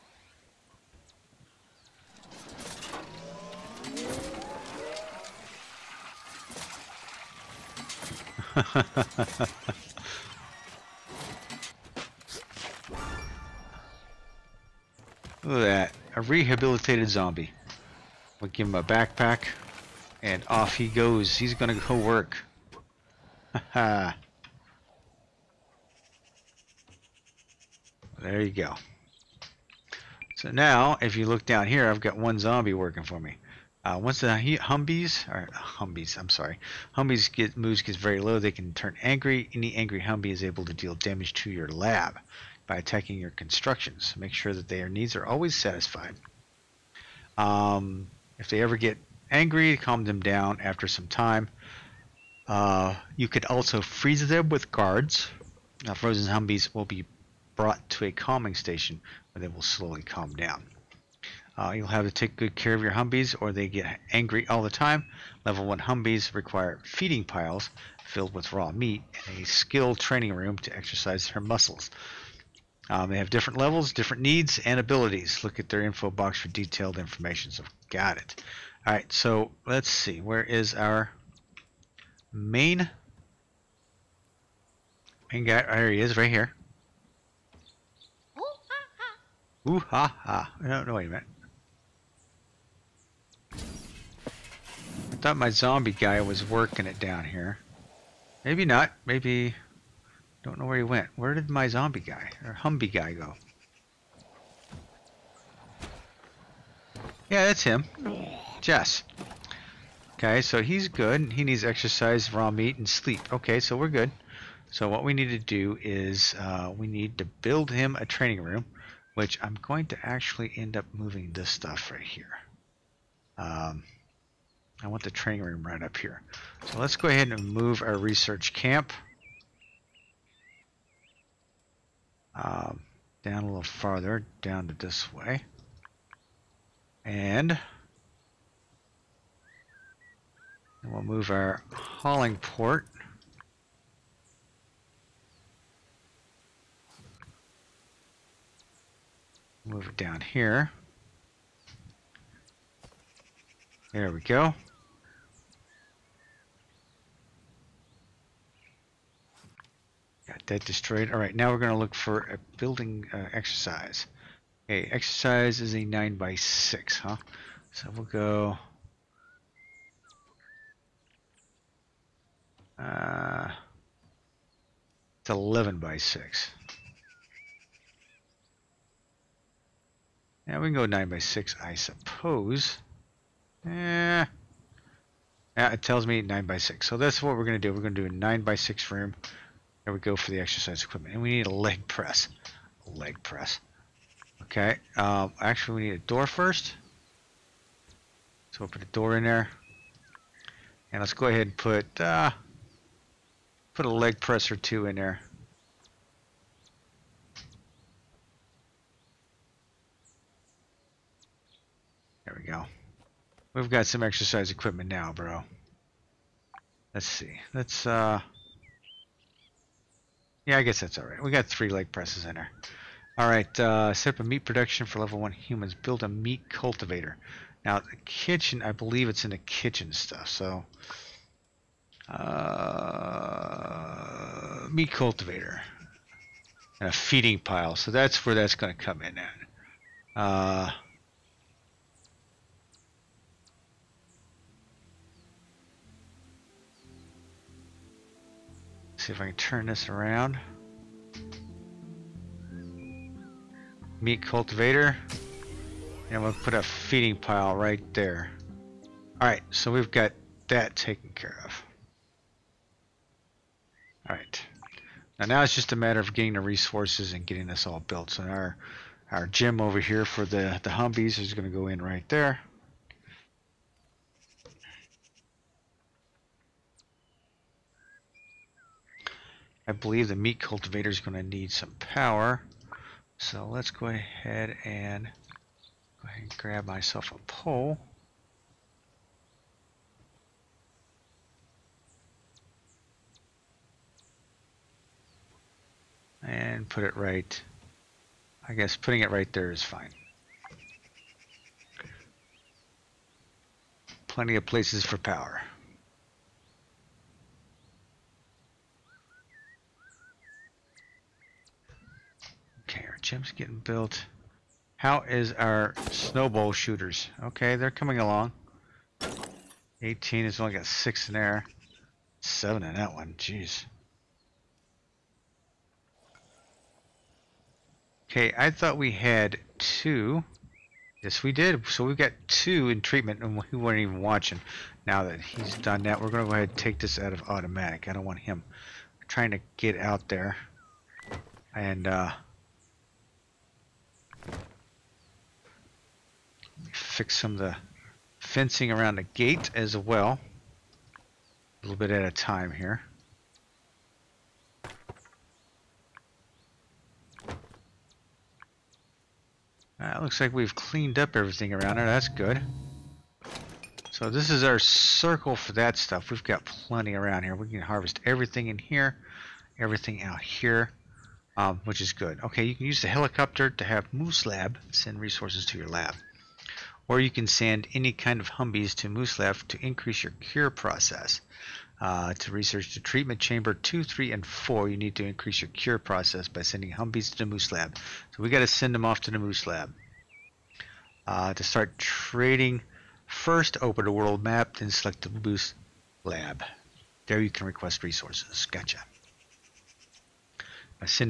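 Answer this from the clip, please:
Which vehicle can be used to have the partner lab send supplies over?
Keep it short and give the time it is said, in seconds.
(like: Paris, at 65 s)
Helicopter, at 372 s.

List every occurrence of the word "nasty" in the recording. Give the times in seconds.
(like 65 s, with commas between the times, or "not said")
not said.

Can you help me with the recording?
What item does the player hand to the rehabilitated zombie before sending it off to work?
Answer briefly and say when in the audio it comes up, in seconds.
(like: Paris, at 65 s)
A backpack, at 18 s.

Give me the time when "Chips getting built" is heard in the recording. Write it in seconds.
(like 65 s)
313 s.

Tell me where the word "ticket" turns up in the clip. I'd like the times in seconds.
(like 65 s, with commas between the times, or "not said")
not said.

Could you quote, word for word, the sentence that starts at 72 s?
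Um, they have different levels, different needs, and abilities.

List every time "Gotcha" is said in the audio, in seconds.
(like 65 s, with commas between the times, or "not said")
398 s.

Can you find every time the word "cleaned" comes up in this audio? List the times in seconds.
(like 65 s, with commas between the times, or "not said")
360 s.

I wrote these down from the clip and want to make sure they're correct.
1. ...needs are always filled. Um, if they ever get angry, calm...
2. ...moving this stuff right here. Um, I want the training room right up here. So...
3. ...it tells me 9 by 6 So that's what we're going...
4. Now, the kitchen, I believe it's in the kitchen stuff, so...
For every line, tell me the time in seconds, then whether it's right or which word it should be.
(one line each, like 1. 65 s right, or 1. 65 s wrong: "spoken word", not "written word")
1. 44 s wrong: "satisfied", not "filled"
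2. 120 s right
3. 185 s right
4. 227 s right.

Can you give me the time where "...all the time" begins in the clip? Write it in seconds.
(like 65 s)
64 s.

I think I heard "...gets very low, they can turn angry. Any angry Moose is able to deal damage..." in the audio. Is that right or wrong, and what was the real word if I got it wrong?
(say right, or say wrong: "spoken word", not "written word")
wrong: "Humbie", not "Moose".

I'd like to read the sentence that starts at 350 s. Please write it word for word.
A little bit at a time here.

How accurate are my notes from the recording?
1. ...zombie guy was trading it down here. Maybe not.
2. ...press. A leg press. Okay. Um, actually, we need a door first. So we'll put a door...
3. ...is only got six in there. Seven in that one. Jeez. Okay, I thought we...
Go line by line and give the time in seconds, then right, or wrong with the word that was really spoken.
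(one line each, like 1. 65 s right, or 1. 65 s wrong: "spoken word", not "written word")
1. 95 s wrong: "working", not "trading"
2. 191 s right
3. 320 s right.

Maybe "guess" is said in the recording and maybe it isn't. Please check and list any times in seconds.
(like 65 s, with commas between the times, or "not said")
220 s, 298 s.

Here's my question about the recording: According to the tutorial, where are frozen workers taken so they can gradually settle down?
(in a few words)
A calming station.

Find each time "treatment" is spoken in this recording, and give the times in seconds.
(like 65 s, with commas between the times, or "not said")
332 s, 382 s.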